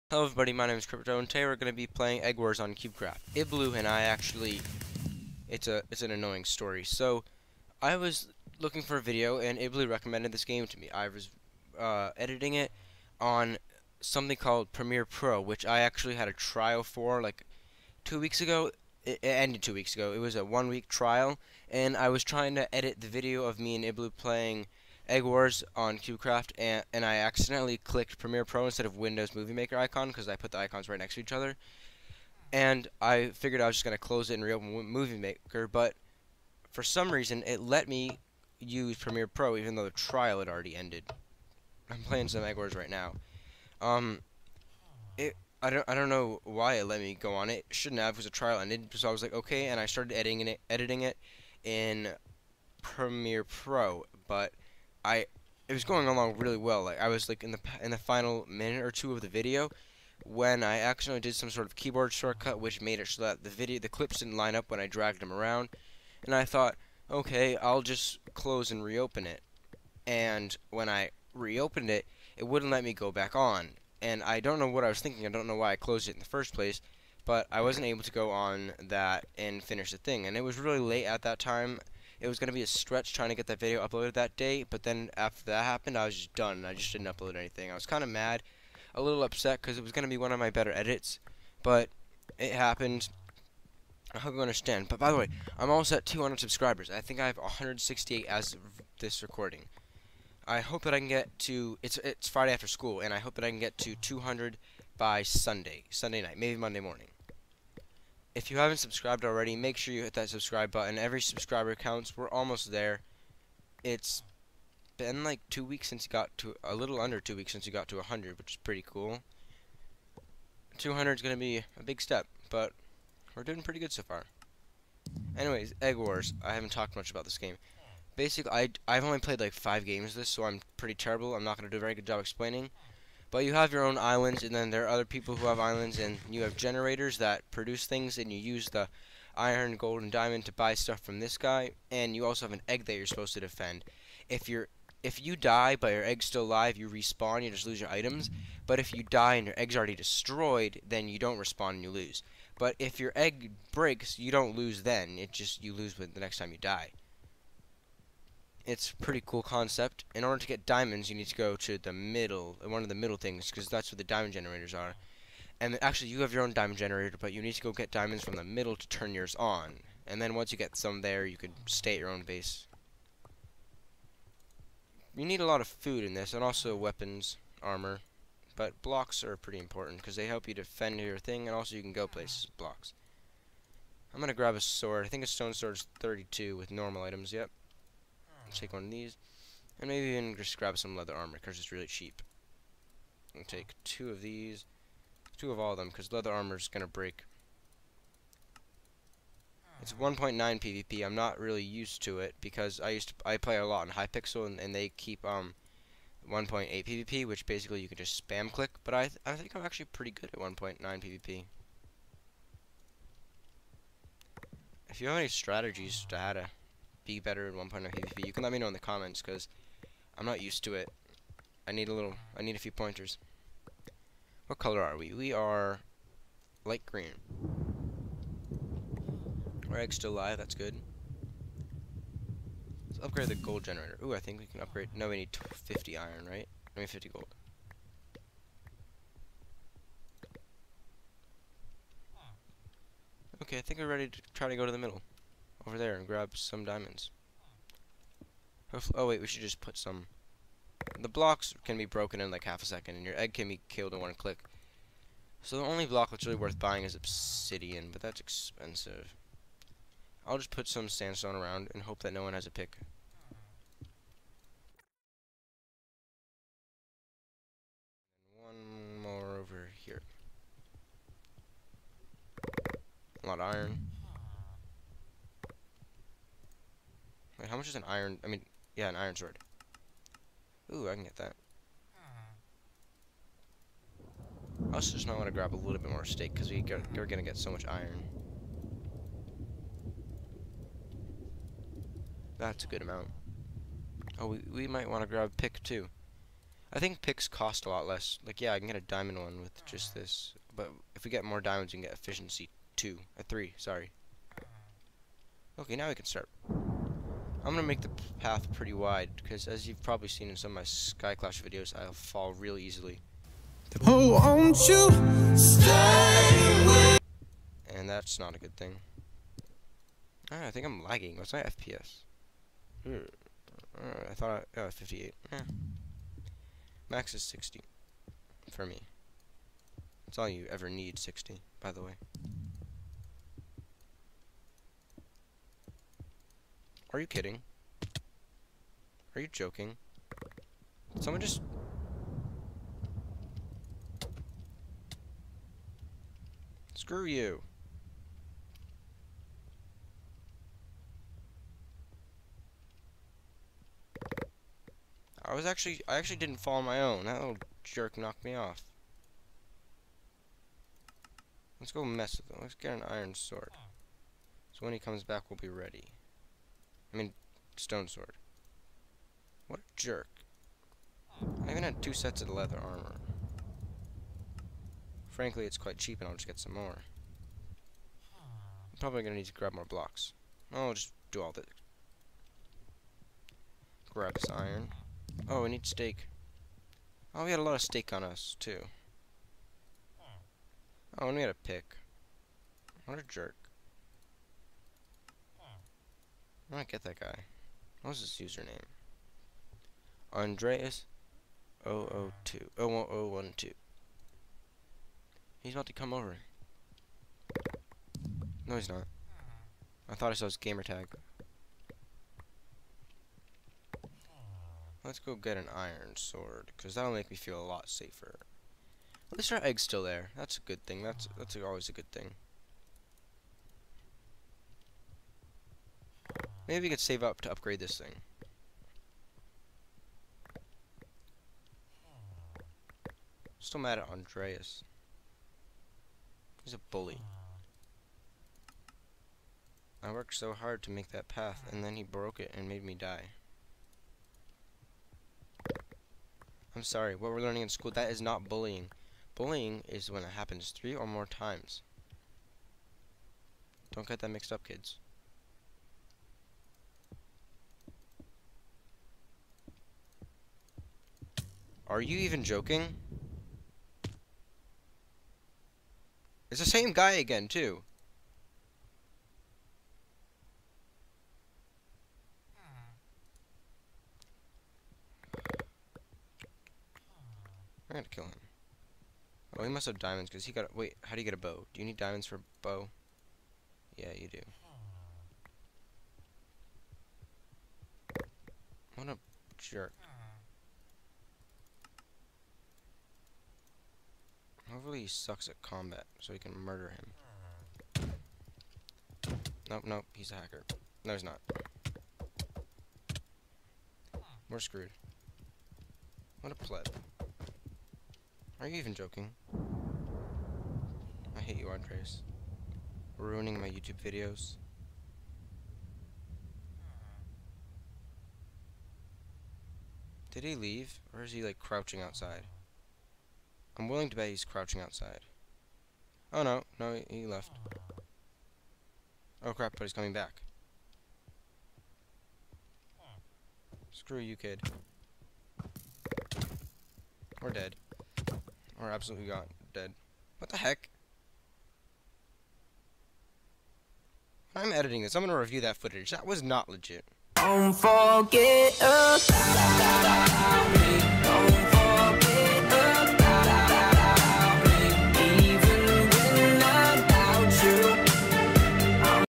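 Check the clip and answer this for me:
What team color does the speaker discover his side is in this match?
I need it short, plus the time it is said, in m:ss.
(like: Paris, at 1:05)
Light green, at 3:46.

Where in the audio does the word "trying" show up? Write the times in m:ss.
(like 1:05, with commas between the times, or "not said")
0:22, 1:23.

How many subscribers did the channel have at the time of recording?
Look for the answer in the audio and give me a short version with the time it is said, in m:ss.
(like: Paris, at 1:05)
168, at 1:37.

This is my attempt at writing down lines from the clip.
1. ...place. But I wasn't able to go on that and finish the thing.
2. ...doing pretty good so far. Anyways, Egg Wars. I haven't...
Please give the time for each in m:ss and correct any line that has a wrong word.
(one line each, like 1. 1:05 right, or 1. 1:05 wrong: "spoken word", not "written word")
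1. 1:16 right
2. 2:03 right.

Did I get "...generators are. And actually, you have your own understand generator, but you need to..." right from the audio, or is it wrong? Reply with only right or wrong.
wrong.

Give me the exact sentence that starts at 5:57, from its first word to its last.
That little jerk knocked me off.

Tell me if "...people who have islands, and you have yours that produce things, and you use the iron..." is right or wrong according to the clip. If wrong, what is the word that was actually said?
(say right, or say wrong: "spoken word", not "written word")
wrong: "generators", not "yours".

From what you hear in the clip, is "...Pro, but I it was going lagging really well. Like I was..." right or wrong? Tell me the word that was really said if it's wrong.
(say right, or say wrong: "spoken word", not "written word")
wrong: "along", not "lagging".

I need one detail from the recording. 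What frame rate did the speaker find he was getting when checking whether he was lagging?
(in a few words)
58.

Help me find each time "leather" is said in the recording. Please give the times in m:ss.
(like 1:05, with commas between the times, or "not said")
3:10, 3:16, 6:12.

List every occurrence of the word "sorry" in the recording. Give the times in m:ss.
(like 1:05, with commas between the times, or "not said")
5:03, 7:26.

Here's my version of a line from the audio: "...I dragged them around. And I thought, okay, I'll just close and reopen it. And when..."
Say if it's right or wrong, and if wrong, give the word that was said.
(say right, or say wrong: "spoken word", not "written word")
right.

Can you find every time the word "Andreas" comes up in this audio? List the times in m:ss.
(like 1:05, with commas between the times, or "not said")
6:40, 7:13, 8:31.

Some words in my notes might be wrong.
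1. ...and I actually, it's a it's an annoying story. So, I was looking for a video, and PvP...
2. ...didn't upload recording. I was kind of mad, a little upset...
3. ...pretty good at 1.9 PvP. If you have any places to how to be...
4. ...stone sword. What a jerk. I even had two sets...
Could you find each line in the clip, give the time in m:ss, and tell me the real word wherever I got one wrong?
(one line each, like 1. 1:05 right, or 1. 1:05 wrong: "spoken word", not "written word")
1. 0:03 wrong: "Iblu", not "PvP"
2. 1:26 wrong: "anything", not "recording"
3. 3:29 wrong: "strategies", not "places"
4. 6:07 right.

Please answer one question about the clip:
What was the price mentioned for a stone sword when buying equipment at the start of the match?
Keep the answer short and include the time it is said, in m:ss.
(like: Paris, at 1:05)
32, at 3:05.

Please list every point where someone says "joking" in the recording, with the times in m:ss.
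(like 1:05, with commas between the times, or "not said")
5:39, 7:42, 8:28.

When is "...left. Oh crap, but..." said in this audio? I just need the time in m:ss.
8:47.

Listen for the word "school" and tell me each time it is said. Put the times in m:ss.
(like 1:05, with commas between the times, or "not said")
1:42, 7:27.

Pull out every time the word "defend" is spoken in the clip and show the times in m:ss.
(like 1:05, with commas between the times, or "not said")
2:23, 3:00.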